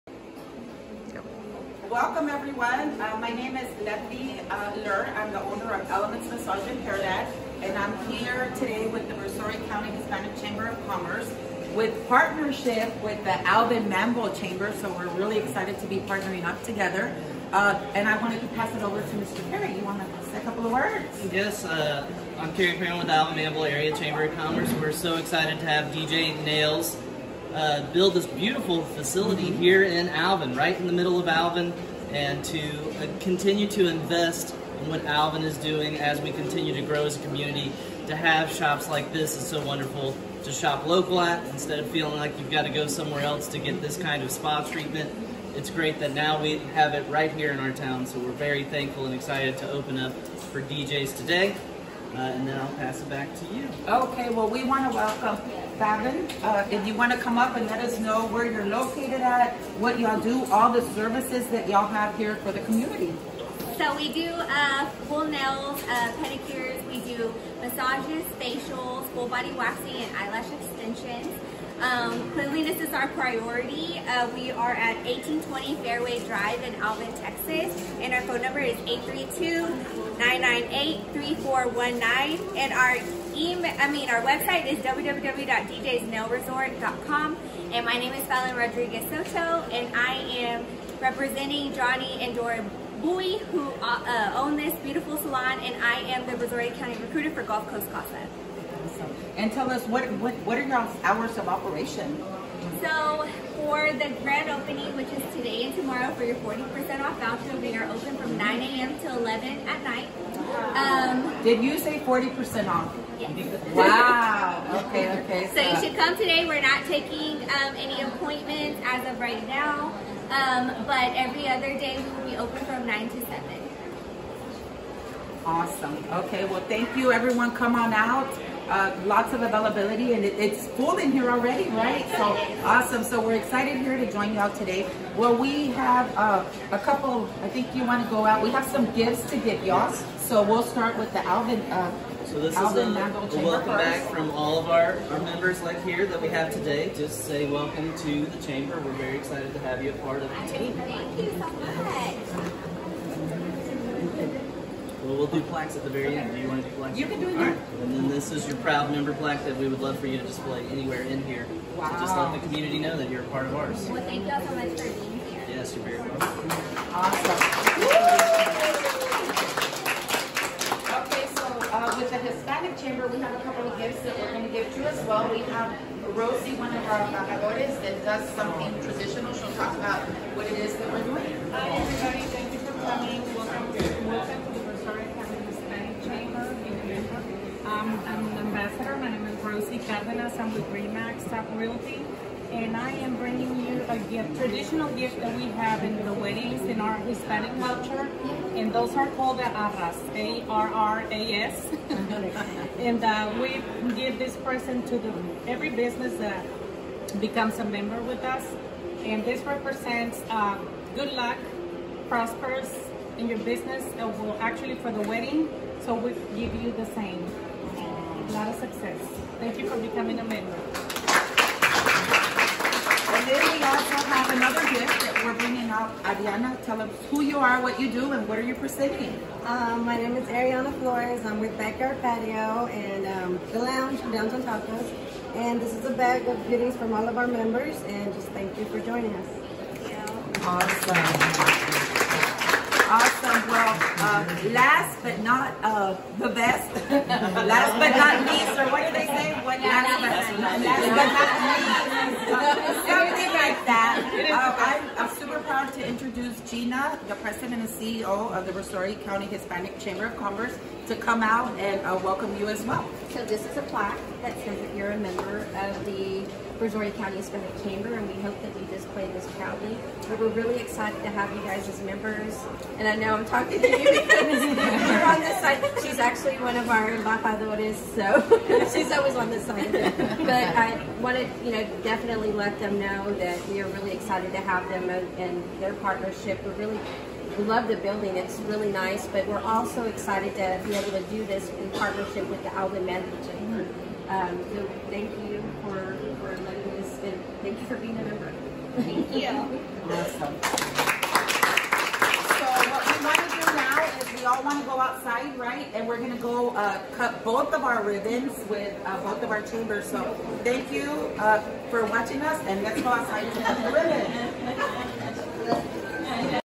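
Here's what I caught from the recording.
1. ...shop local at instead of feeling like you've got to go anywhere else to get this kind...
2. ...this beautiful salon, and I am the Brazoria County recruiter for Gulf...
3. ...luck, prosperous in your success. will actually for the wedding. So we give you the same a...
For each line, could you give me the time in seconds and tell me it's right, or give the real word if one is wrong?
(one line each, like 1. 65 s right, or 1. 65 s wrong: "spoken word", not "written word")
1. 40 s wrong: "somewhere", not "anywhere"
2. 94 s right
3. 211 s wrong: "business", not "success".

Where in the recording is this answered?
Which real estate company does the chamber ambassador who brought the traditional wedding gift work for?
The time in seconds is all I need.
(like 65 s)
190 s.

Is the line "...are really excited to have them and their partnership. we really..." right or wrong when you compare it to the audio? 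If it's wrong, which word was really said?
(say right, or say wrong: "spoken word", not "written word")
right.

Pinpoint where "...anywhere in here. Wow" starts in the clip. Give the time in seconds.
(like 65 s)
160 s.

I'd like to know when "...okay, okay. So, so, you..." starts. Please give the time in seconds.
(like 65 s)
114 s.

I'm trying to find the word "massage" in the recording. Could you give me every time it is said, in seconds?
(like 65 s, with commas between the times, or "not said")
6 s, 67 s.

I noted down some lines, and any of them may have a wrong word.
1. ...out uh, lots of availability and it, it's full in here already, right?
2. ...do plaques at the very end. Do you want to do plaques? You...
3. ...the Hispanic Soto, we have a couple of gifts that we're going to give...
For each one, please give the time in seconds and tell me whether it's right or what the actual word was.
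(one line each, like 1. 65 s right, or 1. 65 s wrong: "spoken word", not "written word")
1. 127 s right
2. 155 s right
3. 172 s wrong: "Chamber", not "Soto".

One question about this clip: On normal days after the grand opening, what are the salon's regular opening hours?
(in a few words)
9 to 7.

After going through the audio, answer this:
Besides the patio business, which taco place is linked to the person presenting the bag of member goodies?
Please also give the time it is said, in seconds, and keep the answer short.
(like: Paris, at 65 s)
Lounge Downtown Tacos, at 233 s.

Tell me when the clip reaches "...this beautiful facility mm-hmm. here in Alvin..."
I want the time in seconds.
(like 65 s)
28 s.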